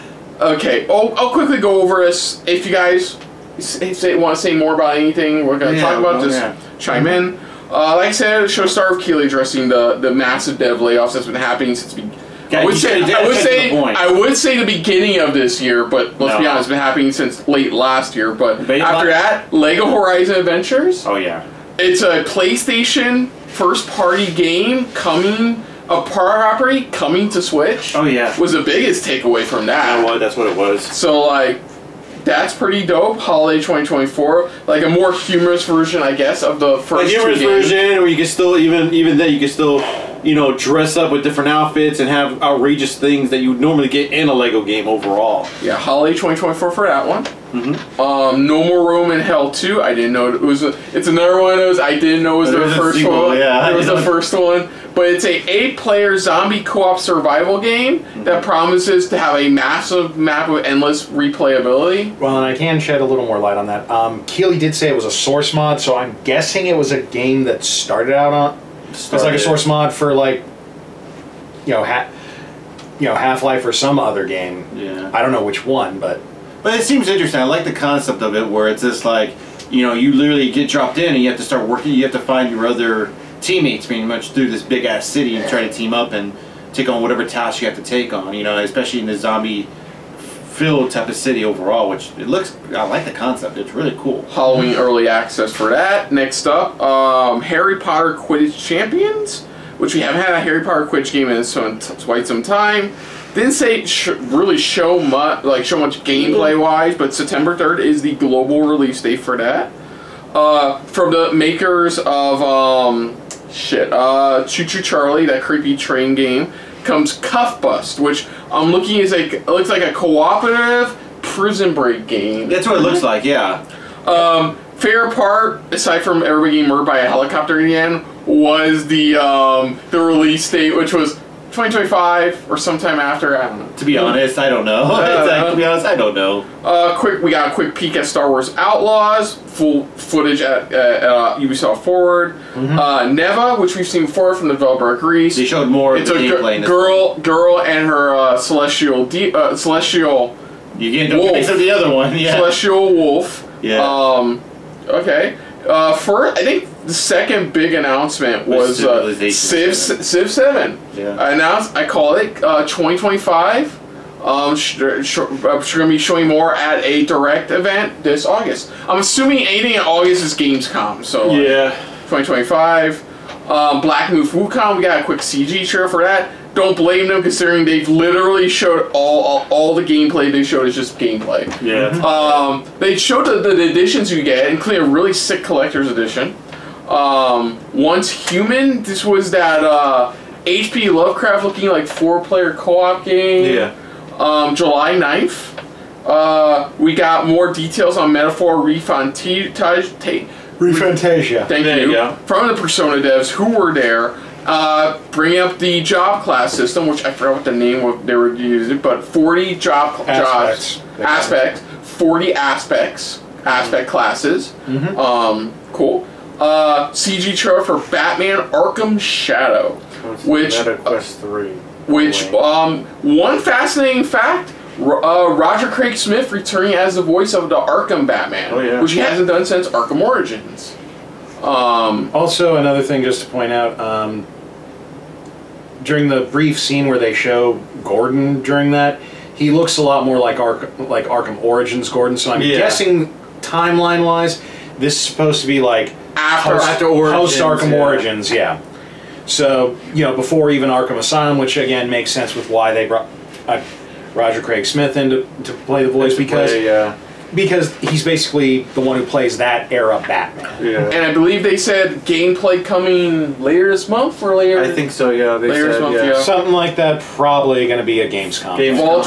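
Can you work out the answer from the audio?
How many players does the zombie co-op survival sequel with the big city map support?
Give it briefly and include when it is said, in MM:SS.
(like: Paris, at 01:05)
8, at 00:55.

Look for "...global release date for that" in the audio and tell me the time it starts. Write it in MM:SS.
01:48.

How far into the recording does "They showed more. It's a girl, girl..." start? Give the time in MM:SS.
02:25.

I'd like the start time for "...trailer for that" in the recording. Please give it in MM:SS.
02:55.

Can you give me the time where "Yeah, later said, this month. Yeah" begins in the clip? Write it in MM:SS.
04:25.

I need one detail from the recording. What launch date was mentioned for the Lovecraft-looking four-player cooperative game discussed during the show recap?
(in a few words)
July 9.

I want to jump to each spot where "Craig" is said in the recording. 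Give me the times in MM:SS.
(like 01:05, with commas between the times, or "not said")
03:45, 04:14.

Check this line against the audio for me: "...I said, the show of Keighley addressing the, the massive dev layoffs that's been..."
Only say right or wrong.
right.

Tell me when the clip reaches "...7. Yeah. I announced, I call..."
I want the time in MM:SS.
02:40.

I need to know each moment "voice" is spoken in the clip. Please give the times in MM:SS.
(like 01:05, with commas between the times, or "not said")
03:47, 04:15.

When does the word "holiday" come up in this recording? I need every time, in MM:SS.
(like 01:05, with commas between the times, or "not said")
00:33, 00:45.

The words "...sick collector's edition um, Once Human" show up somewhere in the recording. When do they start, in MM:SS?
03:05.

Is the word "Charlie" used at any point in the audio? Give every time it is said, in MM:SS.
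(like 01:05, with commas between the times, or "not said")
01:54.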